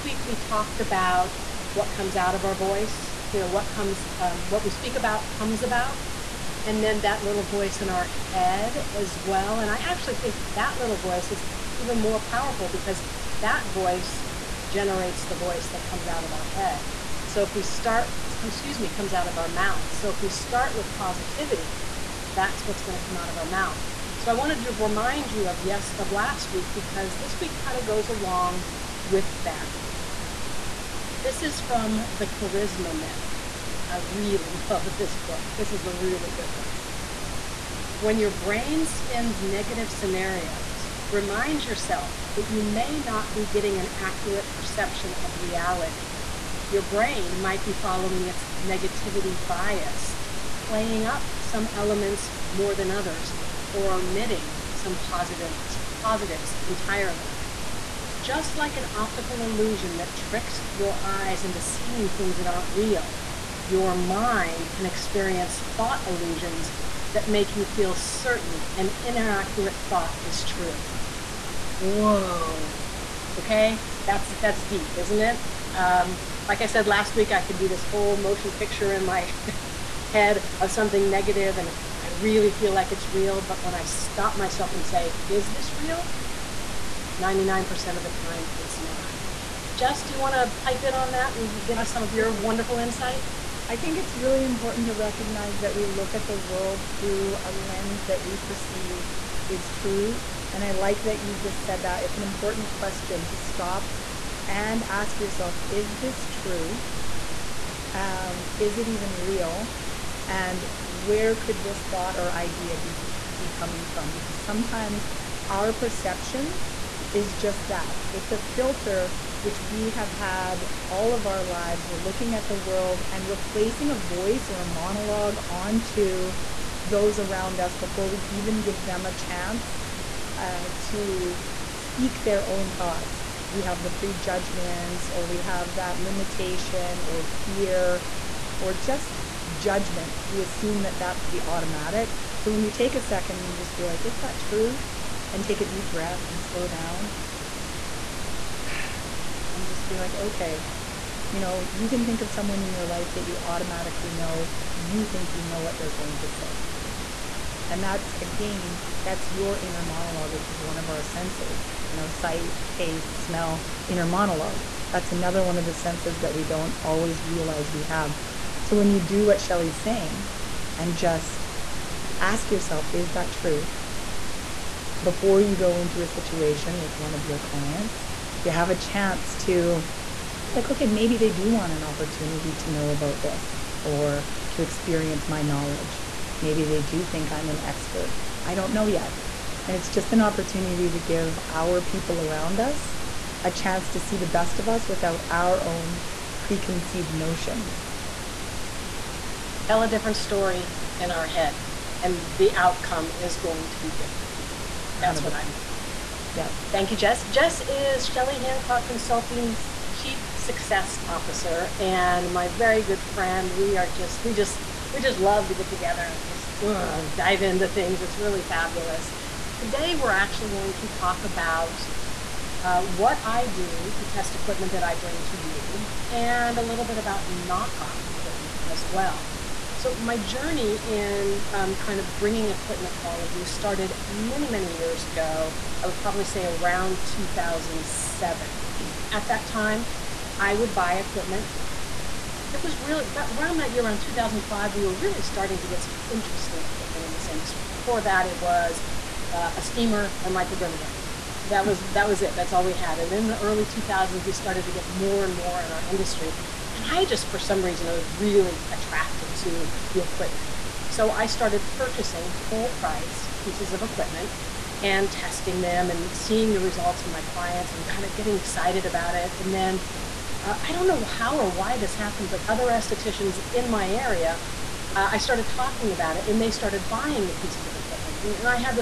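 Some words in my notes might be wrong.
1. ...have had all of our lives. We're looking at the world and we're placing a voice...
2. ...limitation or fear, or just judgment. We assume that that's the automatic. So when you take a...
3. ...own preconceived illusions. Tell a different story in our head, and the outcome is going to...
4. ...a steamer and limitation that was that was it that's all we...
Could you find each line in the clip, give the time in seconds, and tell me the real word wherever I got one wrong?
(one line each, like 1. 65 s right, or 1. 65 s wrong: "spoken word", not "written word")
1. 119 s right
2. 136 s right
3. 195 s wrong: "notions", not "illusions"
4. 249 s wrong: "microdermabrasion", not "limitation".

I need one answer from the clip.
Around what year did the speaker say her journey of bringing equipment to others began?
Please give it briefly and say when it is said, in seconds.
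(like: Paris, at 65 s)
2007, at 237 s.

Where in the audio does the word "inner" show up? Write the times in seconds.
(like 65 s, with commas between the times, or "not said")
159 s, 163 s.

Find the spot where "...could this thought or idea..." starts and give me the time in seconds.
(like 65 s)
111 s.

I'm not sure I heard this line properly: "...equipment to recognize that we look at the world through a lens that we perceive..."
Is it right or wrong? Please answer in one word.
wrong.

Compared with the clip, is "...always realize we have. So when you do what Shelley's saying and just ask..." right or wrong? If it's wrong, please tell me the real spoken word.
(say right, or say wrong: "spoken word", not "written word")
right.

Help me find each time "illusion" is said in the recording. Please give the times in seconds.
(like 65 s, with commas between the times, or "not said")
59 s, 66 s.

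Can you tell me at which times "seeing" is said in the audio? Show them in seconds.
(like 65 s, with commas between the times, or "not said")
61 s, 266 s.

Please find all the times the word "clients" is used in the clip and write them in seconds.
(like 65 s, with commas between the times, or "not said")
177 s, 267 s.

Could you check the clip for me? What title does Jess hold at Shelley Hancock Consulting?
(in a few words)
Chief success officer.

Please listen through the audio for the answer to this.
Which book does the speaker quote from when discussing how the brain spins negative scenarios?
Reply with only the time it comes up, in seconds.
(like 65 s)
32 s.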